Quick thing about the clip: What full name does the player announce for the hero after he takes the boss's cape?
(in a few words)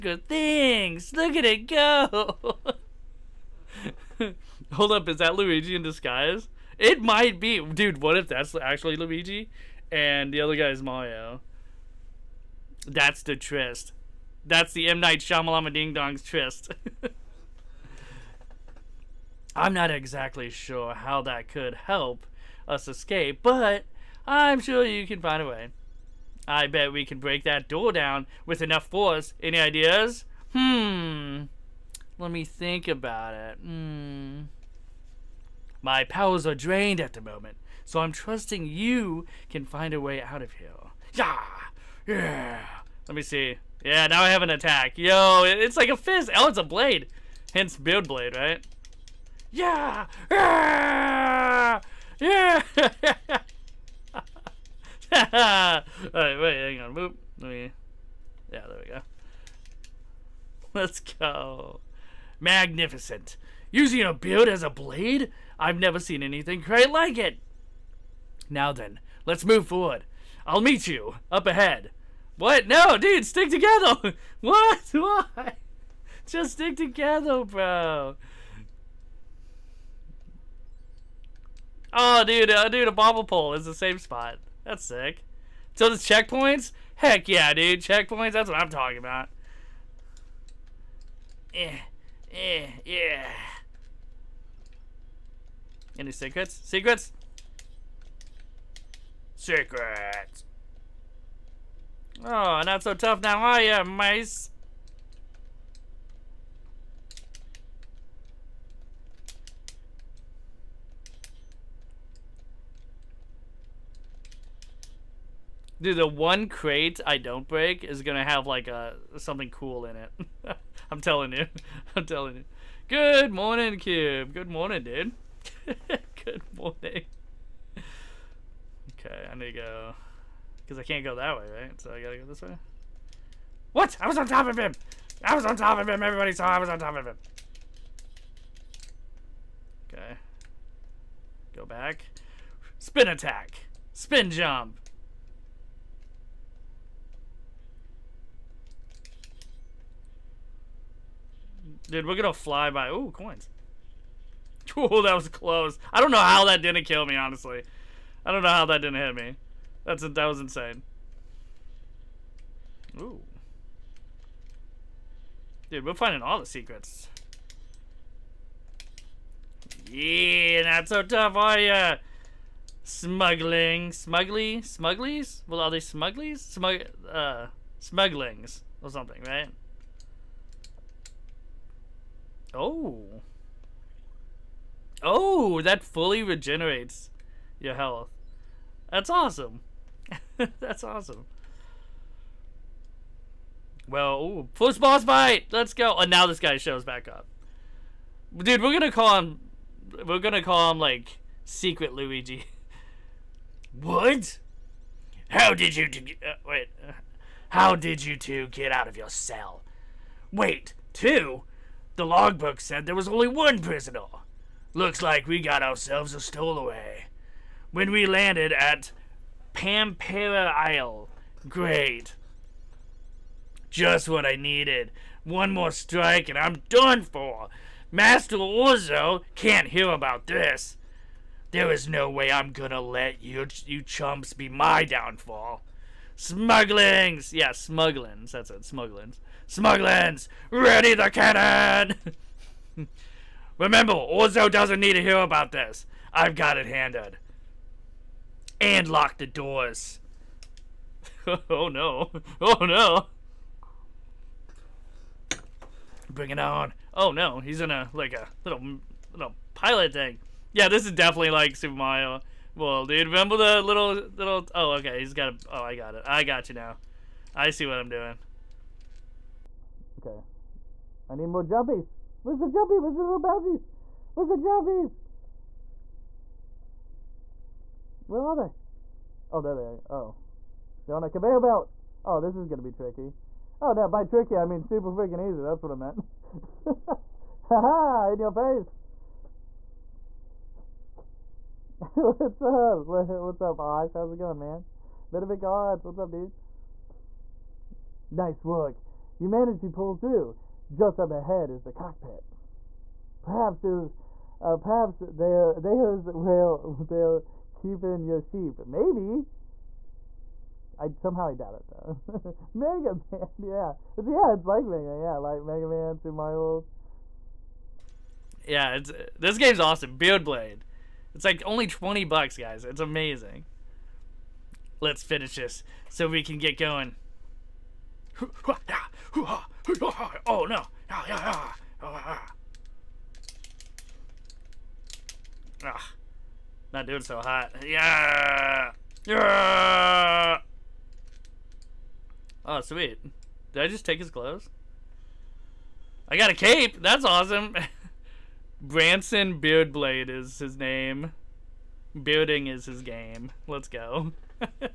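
Branson Beardblade.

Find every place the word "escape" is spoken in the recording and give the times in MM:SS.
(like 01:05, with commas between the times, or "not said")
00:22.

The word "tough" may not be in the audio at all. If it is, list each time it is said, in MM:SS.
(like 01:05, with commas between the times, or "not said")
01:42, 02:51.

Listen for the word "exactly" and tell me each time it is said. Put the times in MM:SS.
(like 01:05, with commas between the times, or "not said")
00:19.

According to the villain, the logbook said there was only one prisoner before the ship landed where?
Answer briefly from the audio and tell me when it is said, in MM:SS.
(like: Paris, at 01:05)
Pampera Isle, at 03:39.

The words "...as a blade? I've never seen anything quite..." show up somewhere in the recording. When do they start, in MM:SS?
01:04.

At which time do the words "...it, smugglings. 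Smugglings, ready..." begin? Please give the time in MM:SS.
03:58.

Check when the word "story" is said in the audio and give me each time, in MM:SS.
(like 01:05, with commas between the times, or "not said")
not said.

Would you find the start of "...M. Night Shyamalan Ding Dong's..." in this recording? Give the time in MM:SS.
00:14.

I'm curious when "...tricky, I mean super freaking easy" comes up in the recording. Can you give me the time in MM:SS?
04:44.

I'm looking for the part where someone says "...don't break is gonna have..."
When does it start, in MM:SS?
01:57.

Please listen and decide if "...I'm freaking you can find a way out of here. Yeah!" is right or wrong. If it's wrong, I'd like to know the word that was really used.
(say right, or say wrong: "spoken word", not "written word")
wrong: "trusting", not "freaking".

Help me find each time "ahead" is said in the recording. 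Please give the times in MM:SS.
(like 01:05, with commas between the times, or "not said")
01:11, 05:01.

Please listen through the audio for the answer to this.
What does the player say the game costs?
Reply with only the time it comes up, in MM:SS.
05:21.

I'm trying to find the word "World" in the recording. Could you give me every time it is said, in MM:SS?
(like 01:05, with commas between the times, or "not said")
05:16.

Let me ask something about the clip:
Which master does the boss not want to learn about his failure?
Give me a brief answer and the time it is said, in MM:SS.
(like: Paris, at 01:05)
Master Orzo, at 03:47.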